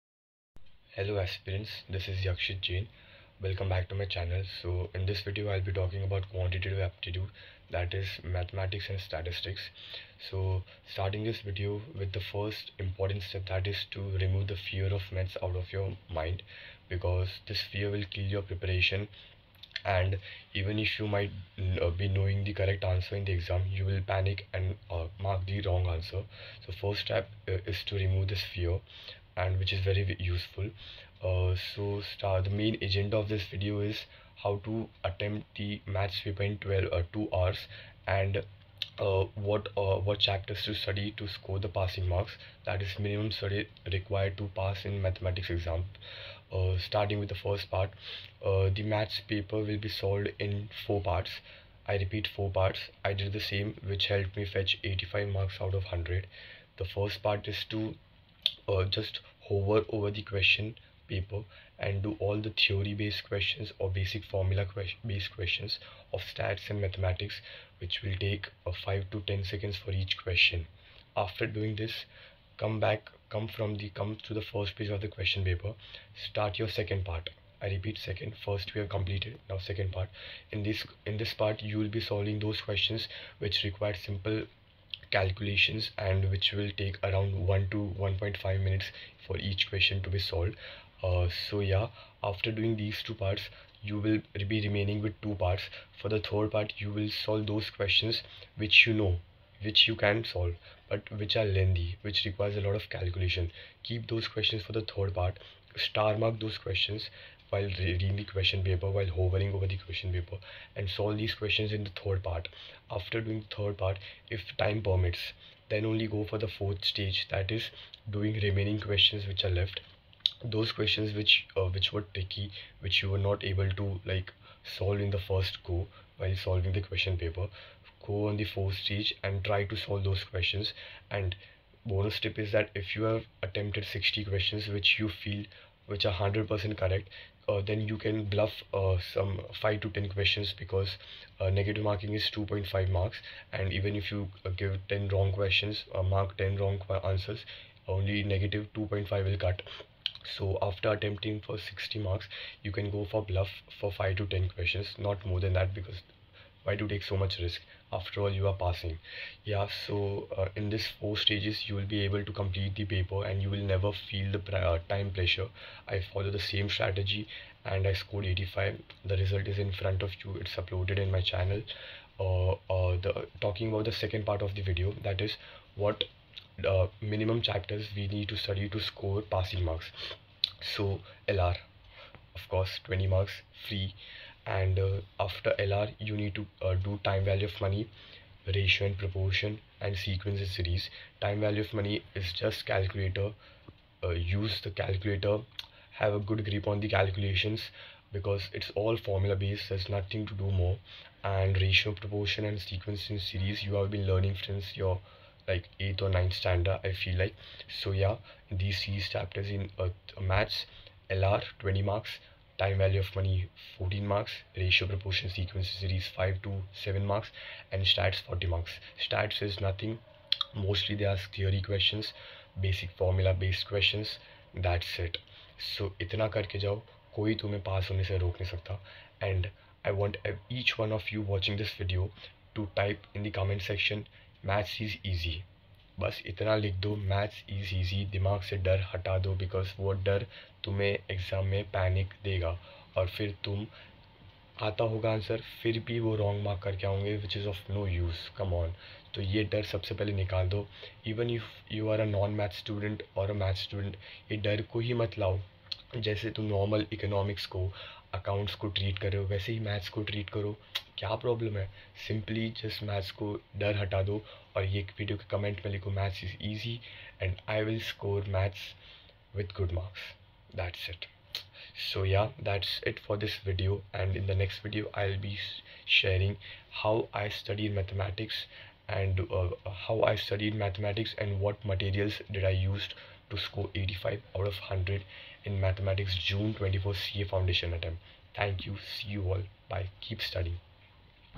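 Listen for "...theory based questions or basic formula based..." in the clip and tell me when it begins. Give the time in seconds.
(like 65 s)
62 s.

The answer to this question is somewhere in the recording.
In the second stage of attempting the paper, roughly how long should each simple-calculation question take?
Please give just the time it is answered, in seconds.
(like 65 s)
87 s.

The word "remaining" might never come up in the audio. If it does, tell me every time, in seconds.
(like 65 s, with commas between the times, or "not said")
94 s, 118 s.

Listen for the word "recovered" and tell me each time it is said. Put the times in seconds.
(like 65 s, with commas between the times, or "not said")
not said.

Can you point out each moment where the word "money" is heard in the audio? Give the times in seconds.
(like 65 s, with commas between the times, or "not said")
187 s, 191 s.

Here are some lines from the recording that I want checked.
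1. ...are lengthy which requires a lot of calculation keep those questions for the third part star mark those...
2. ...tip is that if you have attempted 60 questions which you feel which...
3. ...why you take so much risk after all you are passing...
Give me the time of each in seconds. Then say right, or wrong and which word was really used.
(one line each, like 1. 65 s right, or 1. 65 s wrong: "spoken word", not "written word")
1. 101 s right
2. 132 s right
3. 156 s right.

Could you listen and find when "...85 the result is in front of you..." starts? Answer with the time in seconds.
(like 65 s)
168 s.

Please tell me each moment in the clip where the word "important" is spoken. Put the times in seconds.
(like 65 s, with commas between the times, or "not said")
12 s.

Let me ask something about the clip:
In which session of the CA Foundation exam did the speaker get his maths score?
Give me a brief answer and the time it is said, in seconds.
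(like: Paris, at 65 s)
June 24, at 286 s.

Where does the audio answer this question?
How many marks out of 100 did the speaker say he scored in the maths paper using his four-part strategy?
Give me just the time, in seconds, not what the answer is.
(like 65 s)
54 s.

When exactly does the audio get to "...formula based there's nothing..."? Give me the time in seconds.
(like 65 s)
198 s.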